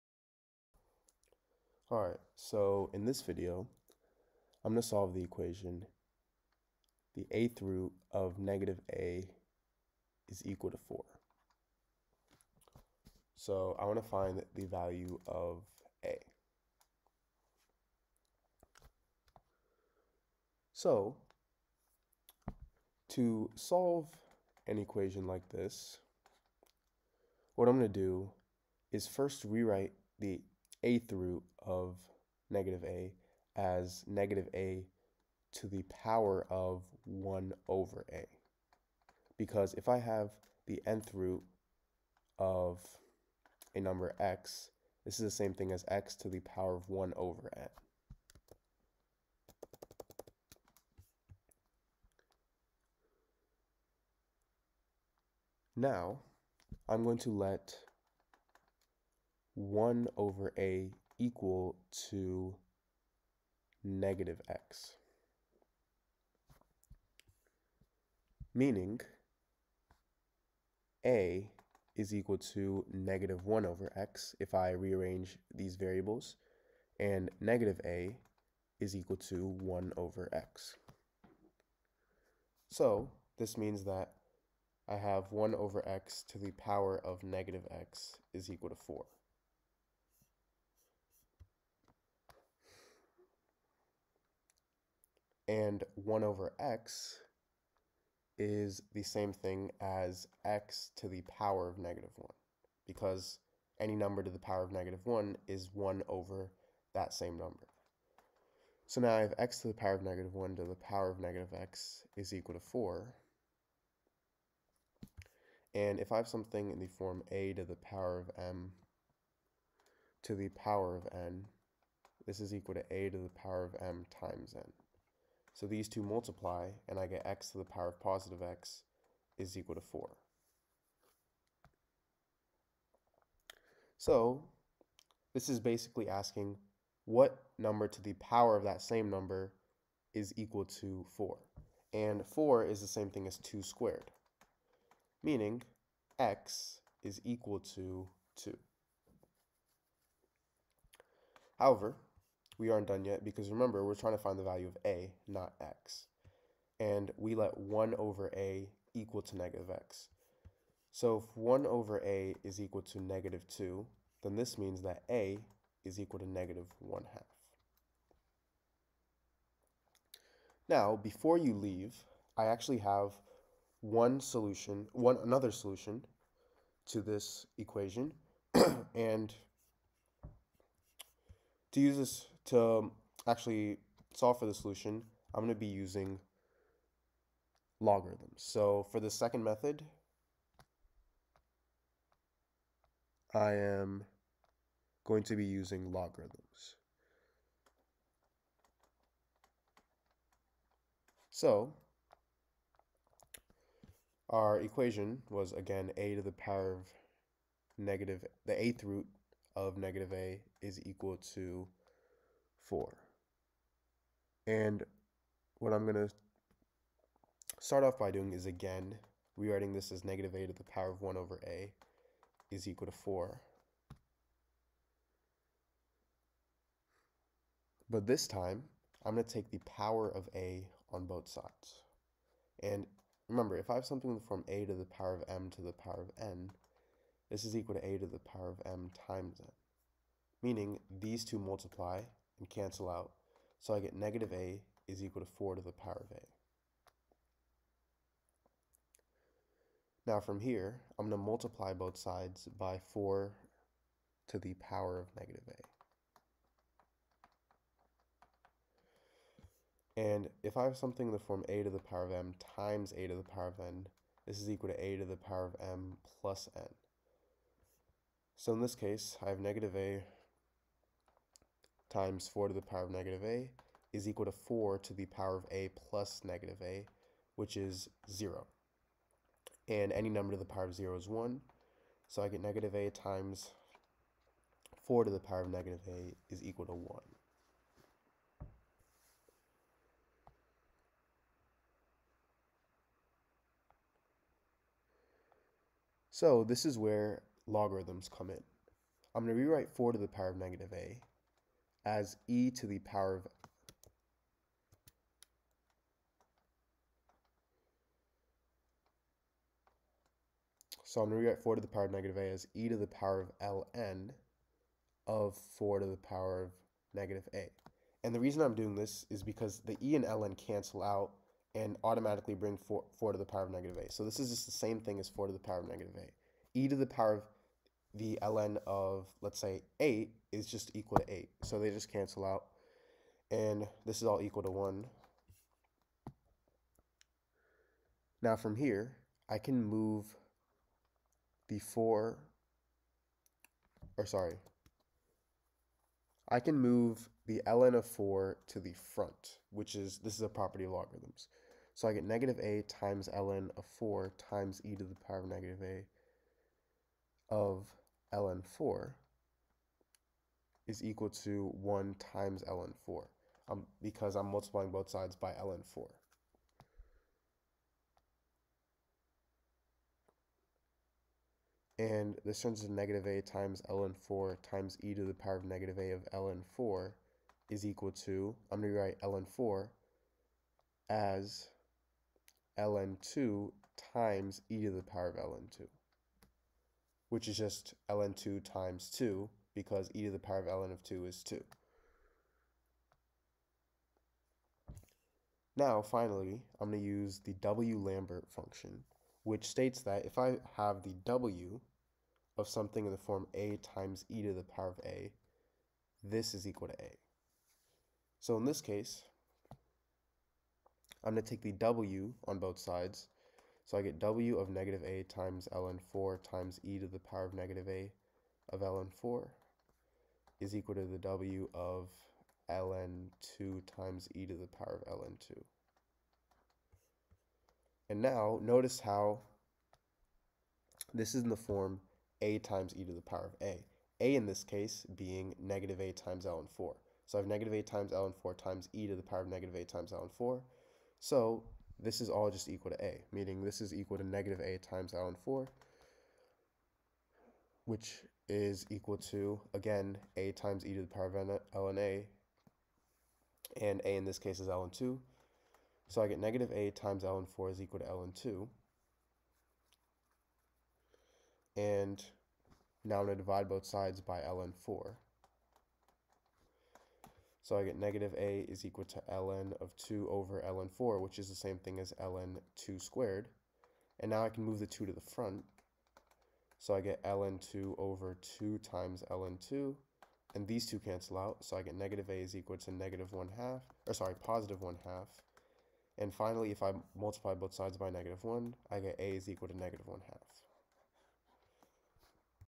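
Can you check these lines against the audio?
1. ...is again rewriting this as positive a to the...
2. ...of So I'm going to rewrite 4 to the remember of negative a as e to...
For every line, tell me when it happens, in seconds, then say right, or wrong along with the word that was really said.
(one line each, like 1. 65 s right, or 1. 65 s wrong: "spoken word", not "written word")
1. 218 s wrong: "negative", not "positive"
2. 303 s wrong: "power", not "remember".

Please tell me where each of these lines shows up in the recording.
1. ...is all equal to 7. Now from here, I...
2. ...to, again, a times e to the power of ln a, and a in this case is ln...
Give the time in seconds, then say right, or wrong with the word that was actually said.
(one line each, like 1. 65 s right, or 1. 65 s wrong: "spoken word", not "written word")
1. 333 s wrong: "1", not "7"
2. 448 s right.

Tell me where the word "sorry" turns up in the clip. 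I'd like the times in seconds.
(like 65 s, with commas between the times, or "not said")
344 s, 483 s.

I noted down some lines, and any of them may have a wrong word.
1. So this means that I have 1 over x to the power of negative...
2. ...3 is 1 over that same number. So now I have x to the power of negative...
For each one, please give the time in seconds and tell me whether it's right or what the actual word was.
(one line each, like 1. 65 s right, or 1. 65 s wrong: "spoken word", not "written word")
1. 82 s right
2. 105 s wrong: "1", not "3".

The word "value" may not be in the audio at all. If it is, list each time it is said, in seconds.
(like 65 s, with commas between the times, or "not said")
14 s, 154 s.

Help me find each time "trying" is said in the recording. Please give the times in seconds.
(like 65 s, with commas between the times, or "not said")
153 s.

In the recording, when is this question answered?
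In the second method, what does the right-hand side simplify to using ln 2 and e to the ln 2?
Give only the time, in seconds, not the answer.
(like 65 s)
387 s.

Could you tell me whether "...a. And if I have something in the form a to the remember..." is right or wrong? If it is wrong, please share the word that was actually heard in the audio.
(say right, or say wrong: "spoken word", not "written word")
wrong: "power", not "remember".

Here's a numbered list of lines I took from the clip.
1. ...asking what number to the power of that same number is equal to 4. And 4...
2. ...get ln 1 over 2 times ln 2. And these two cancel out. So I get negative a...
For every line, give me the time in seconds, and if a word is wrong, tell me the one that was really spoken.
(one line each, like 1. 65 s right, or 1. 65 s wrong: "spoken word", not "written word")
1. 136 s right
2. 476 s wrong: "2", not "1".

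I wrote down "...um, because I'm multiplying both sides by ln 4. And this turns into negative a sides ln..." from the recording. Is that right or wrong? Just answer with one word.
wrong.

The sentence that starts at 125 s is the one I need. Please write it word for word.
So these two multiply, and I get x to the power of positive x is equal to 4.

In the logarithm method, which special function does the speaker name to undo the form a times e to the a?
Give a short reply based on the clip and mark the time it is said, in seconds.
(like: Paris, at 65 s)
W Lambert function, at 397 s.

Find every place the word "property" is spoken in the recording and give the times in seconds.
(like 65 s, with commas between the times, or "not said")
350 s.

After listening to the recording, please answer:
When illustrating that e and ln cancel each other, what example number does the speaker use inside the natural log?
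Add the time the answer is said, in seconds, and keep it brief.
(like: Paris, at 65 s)
8, at 329 s.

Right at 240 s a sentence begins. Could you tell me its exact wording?
Meaning, these two multiply and cancel out.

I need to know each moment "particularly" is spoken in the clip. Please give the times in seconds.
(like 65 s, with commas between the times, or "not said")
not said.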